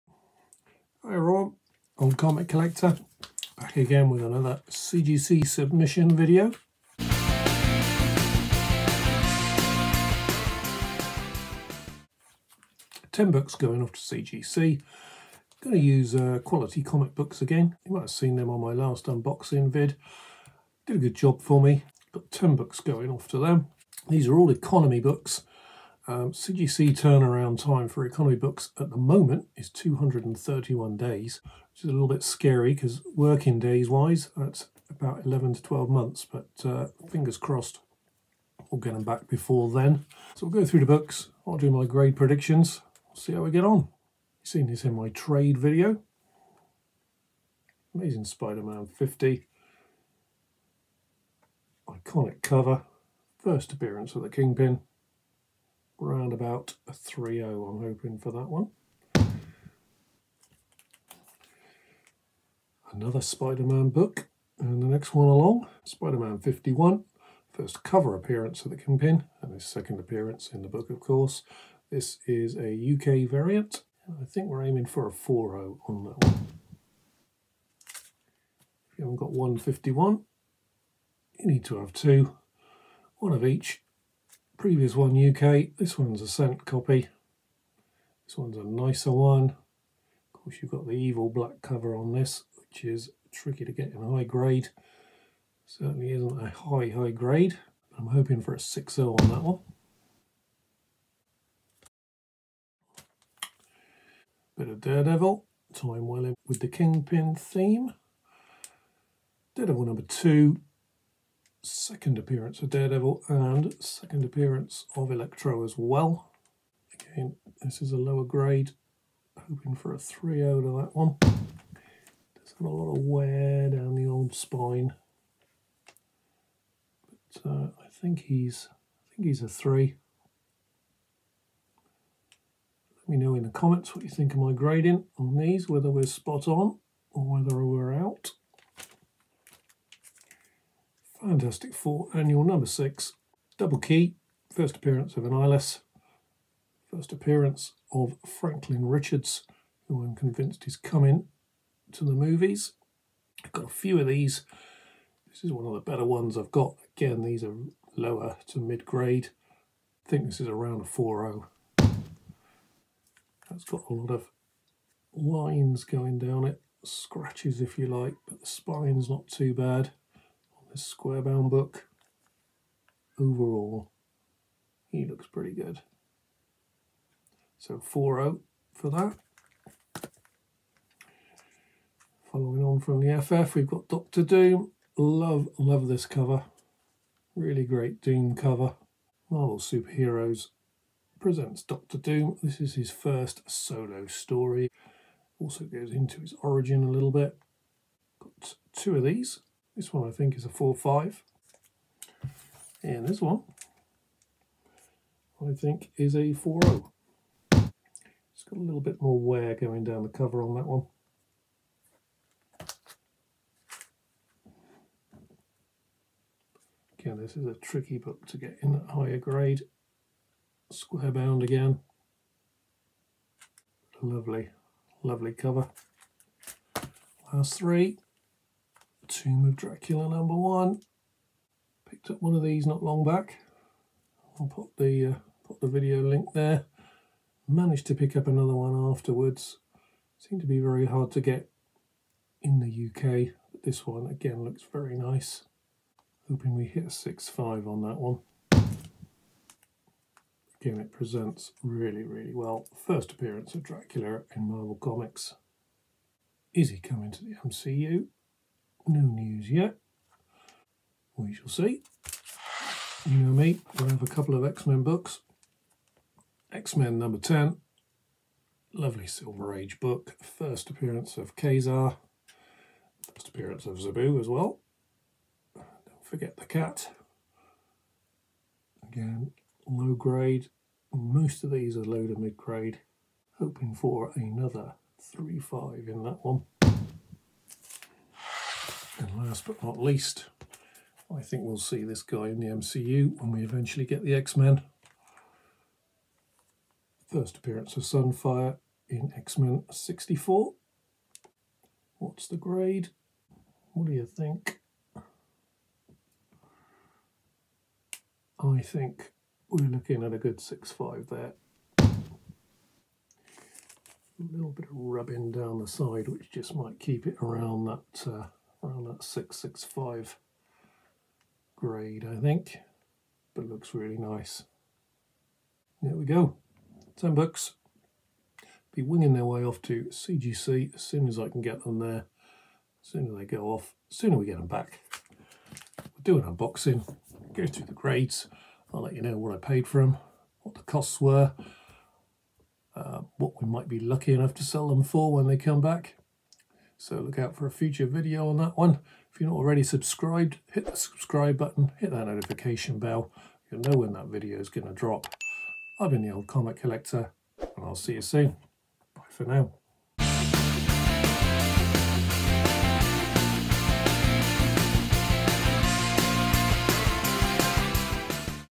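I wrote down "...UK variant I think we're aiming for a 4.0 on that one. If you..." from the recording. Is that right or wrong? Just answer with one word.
right.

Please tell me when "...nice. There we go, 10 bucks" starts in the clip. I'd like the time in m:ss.
5:23.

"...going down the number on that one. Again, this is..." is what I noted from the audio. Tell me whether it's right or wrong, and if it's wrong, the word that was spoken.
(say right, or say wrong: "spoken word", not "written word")
wrong: "cover", not "number".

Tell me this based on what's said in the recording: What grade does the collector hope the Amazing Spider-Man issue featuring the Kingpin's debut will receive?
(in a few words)
3.0.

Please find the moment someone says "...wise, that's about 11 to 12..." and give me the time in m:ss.
0:33.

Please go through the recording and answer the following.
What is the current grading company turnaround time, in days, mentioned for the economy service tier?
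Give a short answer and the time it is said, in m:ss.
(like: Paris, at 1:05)
231 days, at 0:29.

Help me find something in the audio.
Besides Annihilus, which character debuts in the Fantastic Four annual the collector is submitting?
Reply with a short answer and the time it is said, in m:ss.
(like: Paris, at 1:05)
Franklin Richards, at 2:28.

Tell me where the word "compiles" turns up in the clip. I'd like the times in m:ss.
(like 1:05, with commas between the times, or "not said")
not said.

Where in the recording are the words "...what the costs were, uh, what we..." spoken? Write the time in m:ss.
5:40.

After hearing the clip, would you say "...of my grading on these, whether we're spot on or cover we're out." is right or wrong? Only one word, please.
wrong.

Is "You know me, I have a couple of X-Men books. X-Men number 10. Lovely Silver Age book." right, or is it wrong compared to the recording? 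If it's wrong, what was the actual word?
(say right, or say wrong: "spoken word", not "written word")
right.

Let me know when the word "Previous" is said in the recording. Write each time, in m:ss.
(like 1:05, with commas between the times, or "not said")
1:24.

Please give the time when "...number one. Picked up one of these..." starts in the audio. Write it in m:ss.
3:50.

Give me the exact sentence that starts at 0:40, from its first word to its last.
So we'll go through the books, I'll do my grade predictions, see how we get on.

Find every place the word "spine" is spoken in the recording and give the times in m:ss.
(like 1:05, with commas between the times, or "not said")
2:04, 2:48.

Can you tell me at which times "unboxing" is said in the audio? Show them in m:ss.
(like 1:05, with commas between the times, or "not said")
0:19, 5:36.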